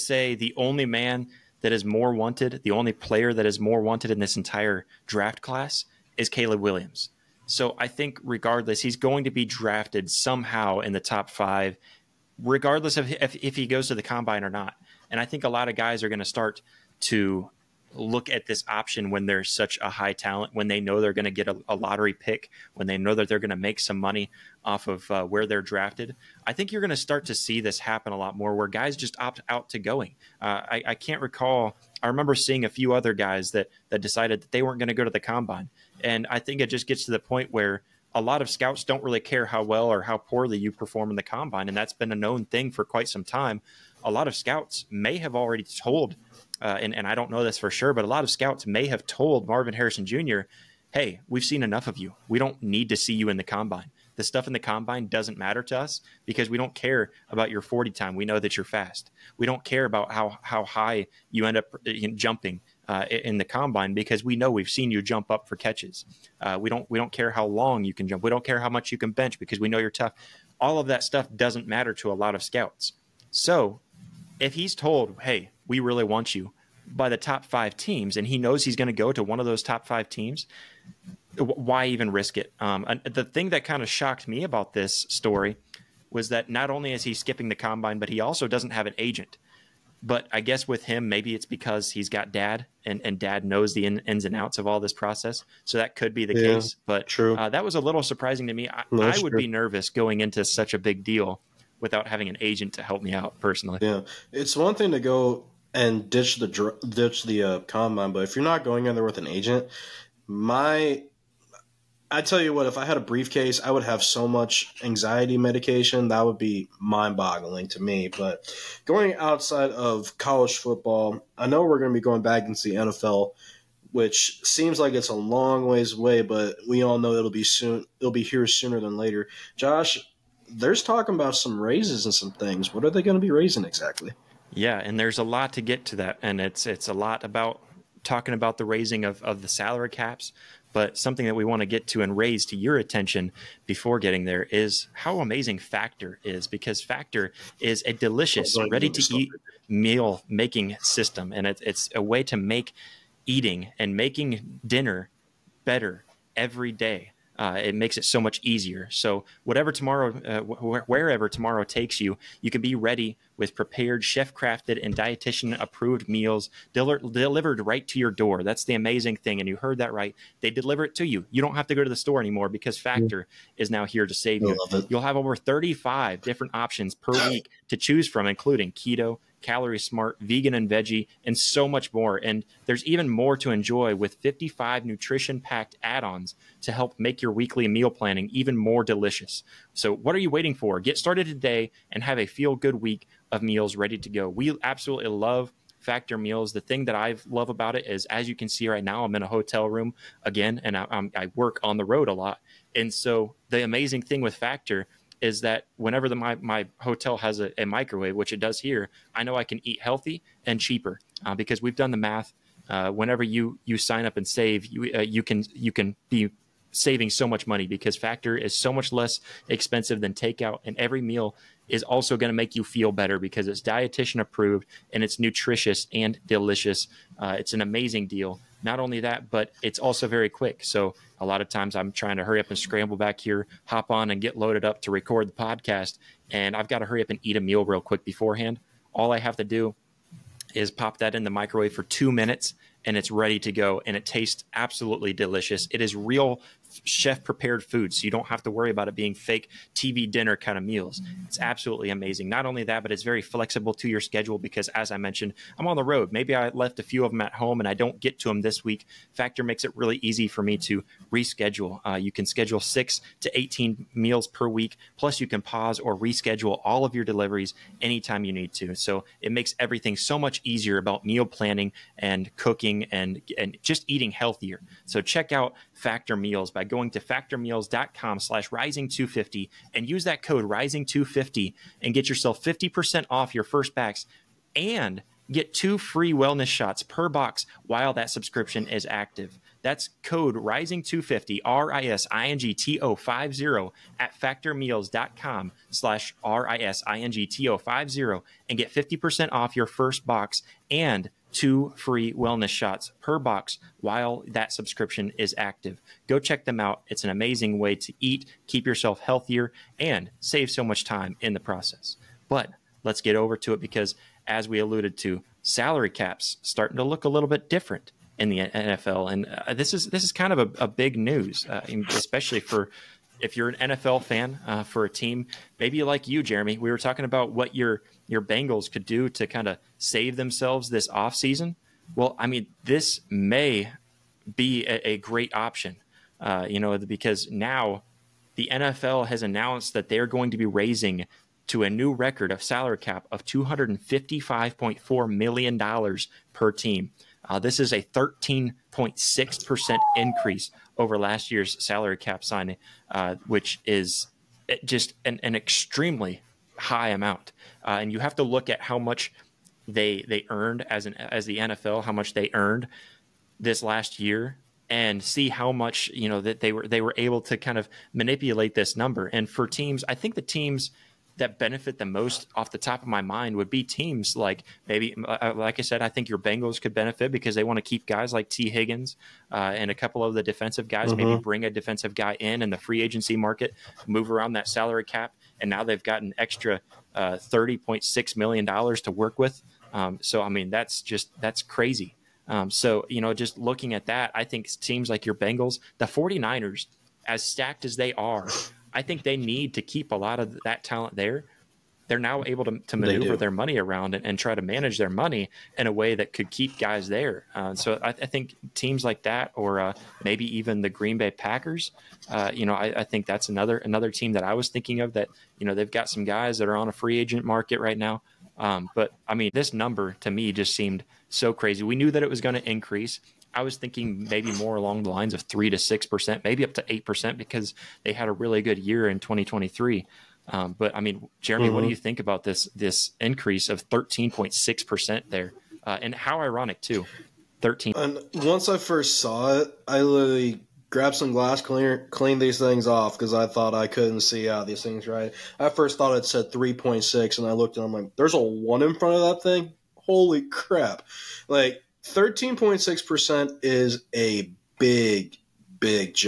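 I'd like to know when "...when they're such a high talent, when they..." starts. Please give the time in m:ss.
0:19.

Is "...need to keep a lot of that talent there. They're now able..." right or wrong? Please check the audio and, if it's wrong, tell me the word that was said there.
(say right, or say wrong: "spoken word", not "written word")
right.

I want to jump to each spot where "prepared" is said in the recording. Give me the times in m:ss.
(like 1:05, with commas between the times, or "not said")
2:43, 4:07.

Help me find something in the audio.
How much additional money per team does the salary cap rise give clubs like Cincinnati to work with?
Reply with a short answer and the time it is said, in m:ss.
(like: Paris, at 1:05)
$30.6 million, at 6:27.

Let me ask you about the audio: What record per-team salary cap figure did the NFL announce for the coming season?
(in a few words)
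$255.4 million.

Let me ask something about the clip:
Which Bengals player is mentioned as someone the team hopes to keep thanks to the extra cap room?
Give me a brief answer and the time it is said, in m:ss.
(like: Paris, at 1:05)
Tee Higgins, at 6:18.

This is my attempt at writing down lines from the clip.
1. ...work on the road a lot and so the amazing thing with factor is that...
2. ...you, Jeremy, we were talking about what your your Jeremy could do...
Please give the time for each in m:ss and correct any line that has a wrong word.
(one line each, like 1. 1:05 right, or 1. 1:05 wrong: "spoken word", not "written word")
1. 3:21 right
2. 5:26 wrong: "Bengals", not "Jeremy".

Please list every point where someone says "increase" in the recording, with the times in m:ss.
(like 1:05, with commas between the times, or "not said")
5:49, 7:02, 7:12.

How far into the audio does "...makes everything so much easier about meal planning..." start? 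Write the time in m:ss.
4:29.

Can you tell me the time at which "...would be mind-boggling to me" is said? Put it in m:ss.
1:56.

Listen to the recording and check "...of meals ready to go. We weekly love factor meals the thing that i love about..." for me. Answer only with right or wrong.
wrong.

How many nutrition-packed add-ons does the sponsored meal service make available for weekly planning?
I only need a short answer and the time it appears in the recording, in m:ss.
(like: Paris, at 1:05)
55, at 3:04.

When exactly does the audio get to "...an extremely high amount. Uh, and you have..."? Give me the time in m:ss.
5:55.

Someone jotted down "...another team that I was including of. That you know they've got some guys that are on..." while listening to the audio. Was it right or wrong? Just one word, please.
wrong.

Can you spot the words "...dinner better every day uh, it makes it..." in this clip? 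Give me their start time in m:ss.
2:34.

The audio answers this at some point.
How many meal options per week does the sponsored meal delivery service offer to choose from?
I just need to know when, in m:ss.
2:55.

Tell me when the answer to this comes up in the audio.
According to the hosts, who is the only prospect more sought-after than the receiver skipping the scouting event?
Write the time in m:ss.
0:06.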